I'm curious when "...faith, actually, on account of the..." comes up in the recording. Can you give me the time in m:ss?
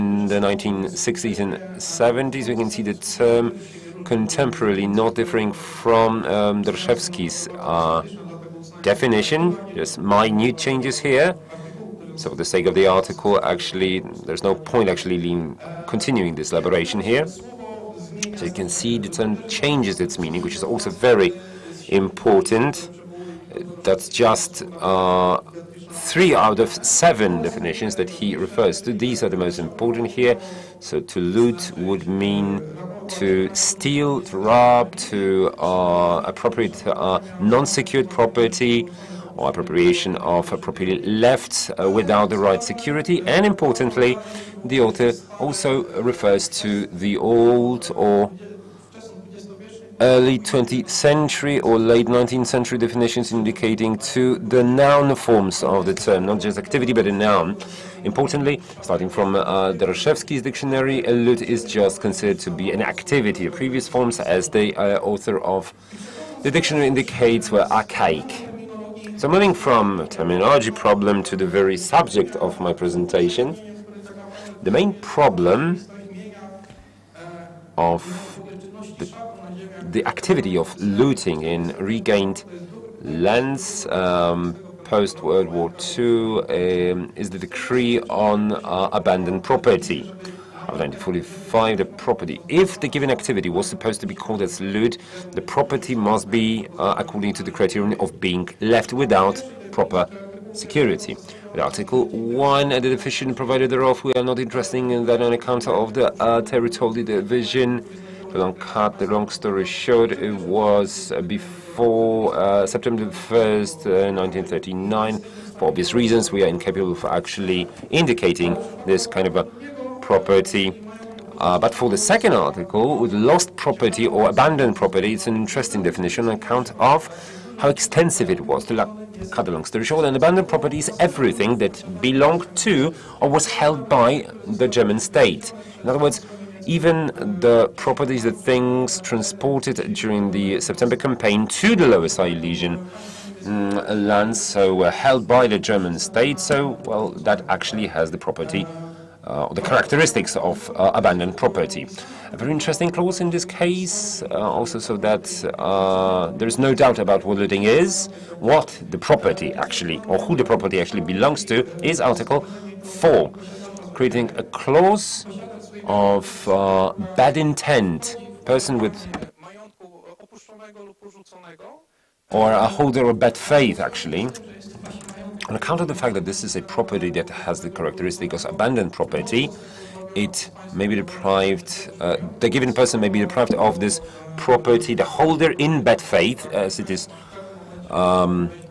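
2:53.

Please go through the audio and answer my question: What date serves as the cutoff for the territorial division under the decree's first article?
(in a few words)
September 1, 1939.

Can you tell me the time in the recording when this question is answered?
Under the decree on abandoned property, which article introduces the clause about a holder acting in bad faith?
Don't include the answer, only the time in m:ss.
2:41.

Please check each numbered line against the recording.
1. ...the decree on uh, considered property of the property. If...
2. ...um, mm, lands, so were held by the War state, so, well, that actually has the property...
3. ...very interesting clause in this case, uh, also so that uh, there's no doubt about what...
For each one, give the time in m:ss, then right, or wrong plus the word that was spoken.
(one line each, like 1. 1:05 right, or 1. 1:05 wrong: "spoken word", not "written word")
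1. 1:27 wrong: "abandoned", not "considered"
2. 2:22 wrong: "German", not "War"
3. 2:32 right.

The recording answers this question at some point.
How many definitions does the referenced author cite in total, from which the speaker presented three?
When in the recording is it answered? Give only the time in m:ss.
0:26.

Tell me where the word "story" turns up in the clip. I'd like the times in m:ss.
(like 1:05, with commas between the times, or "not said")
1:49, 2:09.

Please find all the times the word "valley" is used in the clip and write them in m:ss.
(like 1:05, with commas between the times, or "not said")
not said.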